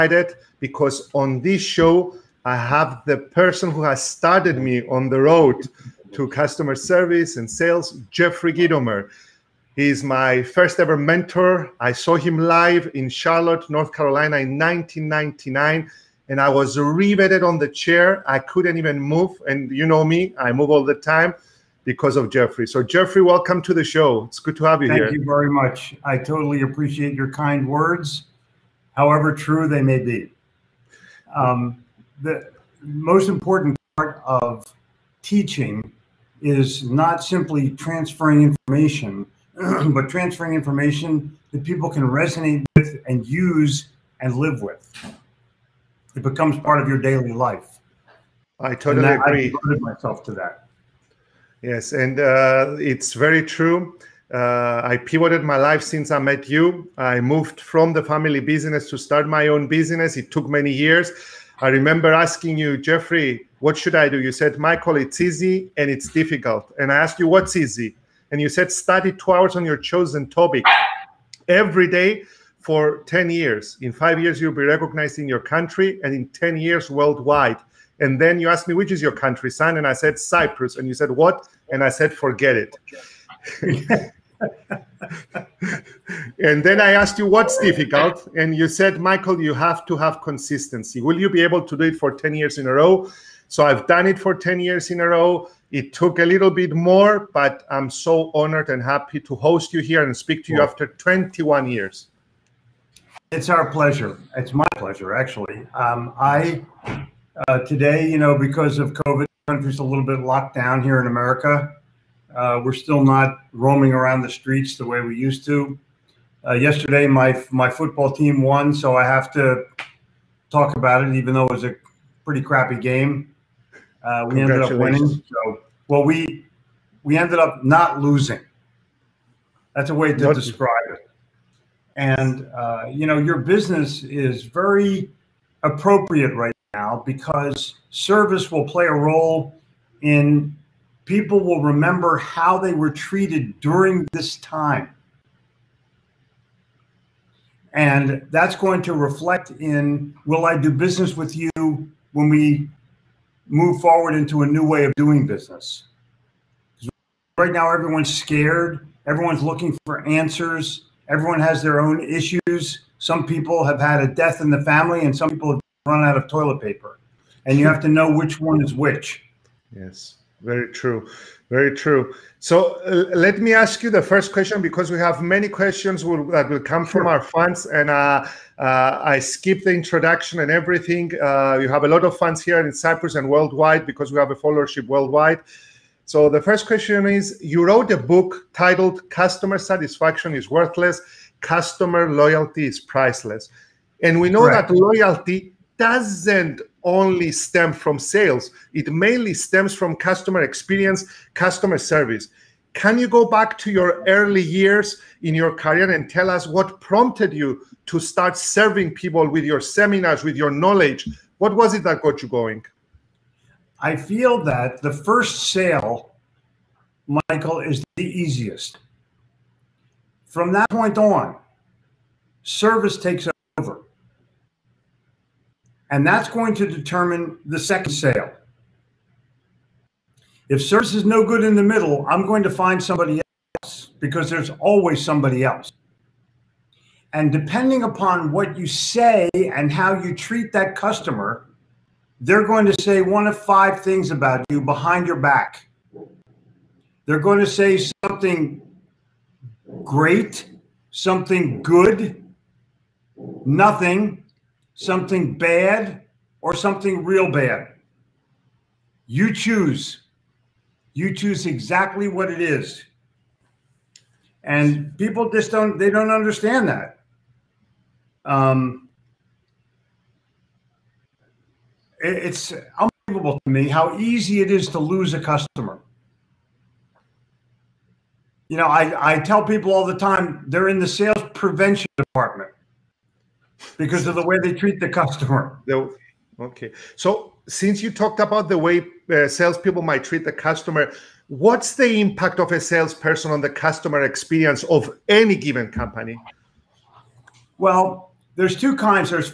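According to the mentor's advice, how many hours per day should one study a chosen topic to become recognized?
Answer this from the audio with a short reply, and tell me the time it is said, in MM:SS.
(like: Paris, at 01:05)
2, at 01:09.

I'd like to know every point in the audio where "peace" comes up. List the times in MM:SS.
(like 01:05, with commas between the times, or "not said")
not said.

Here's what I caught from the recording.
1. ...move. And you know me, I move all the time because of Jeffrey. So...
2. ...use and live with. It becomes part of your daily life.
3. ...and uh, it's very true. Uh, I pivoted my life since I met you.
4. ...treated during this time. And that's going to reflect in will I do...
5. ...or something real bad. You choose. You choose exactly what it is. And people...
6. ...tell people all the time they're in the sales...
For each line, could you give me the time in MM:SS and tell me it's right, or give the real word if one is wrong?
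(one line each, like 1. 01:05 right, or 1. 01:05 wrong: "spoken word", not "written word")
1. 00:19 right
2. 00:43 right
3. 00:51 right
4. 02:22 right
5. 04:16 right
6. 04:39 right.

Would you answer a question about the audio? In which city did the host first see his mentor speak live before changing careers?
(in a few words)
Charlotte, North Carolina.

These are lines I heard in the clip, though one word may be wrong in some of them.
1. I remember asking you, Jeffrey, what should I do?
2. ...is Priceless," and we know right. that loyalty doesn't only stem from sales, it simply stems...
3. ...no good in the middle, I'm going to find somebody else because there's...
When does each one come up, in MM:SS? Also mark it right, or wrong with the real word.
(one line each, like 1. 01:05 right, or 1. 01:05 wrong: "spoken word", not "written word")
1. 01:01 right
2. 03:12 wrong: "mainly", not "simply"
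3. 03:51 right.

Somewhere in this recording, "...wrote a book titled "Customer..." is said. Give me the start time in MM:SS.
03:07.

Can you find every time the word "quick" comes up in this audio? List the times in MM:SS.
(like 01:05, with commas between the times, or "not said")
not said.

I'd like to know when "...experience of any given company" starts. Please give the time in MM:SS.
04:54.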